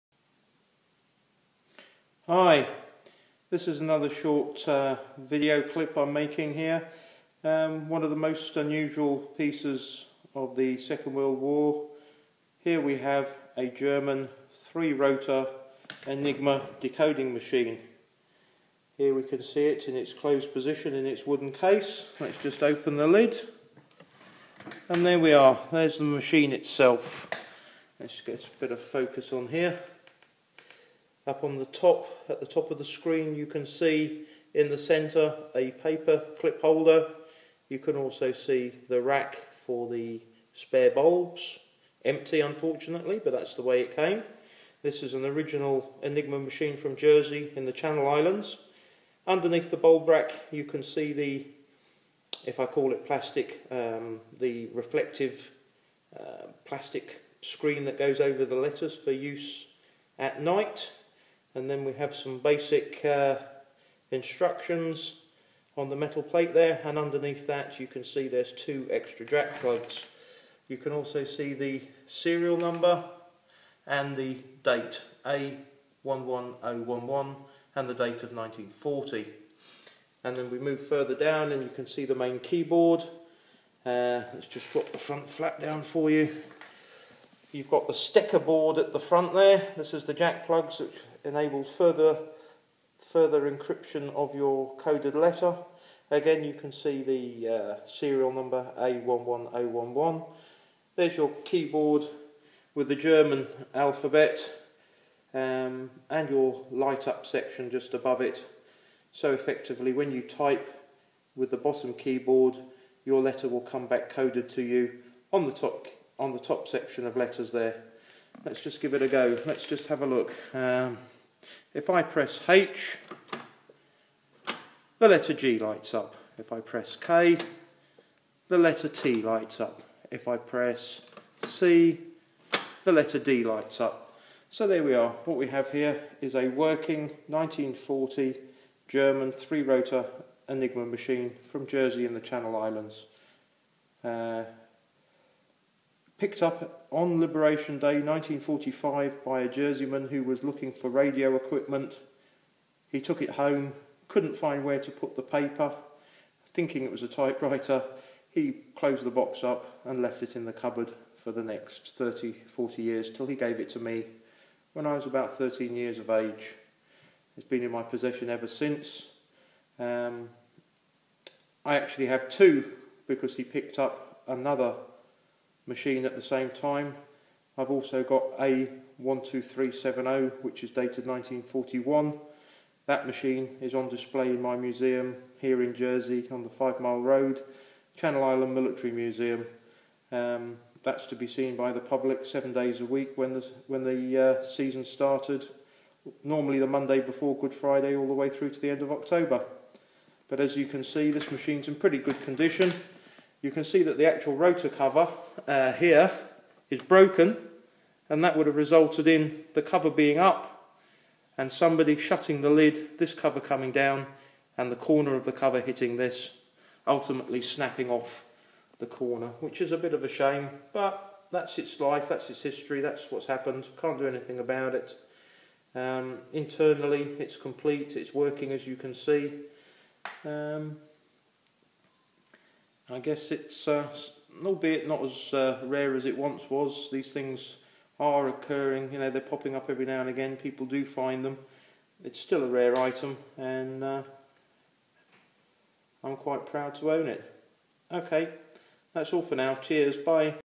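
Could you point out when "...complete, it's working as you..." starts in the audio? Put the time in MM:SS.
03:47.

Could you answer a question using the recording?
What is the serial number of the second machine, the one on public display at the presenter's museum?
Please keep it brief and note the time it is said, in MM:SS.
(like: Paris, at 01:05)
A12370, at 02:58.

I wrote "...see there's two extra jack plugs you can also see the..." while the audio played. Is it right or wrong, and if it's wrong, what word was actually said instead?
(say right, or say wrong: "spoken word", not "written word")
right.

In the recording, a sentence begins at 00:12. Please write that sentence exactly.
Here we have a German three-rotor Enigma decoding machine.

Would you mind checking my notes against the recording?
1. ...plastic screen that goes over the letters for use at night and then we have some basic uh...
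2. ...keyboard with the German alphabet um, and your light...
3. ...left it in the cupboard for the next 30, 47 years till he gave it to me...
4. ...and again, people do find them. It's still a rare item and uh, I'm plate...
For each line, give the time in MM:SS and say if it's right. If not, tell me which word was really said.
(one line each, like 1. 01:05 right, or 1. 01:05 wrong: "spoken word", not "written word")
1. 00:56 right
2. 01:41 right
3. 02:40 wrong: "40", not "47"
4. 04:00 wrong: "quite", not "plate".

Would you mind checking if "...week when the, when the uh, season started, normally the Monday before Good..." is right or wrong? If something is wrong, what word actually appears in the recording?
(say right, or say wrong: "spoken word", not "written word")
right.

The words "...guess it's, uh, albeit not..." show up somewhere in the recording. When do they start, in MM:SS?
03:52.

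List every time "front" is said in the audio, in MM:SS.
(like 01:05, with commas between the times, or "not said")
01:24, 01:28.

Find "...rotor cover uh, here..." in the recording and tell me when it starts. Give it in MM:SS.
03:24.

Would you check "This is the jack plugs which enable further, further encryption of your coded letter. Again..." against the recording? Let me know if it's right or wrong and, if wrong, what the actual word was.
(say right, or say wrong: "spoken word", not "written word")
right.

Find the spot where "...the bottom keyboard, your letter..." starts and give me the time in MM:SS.
01:51.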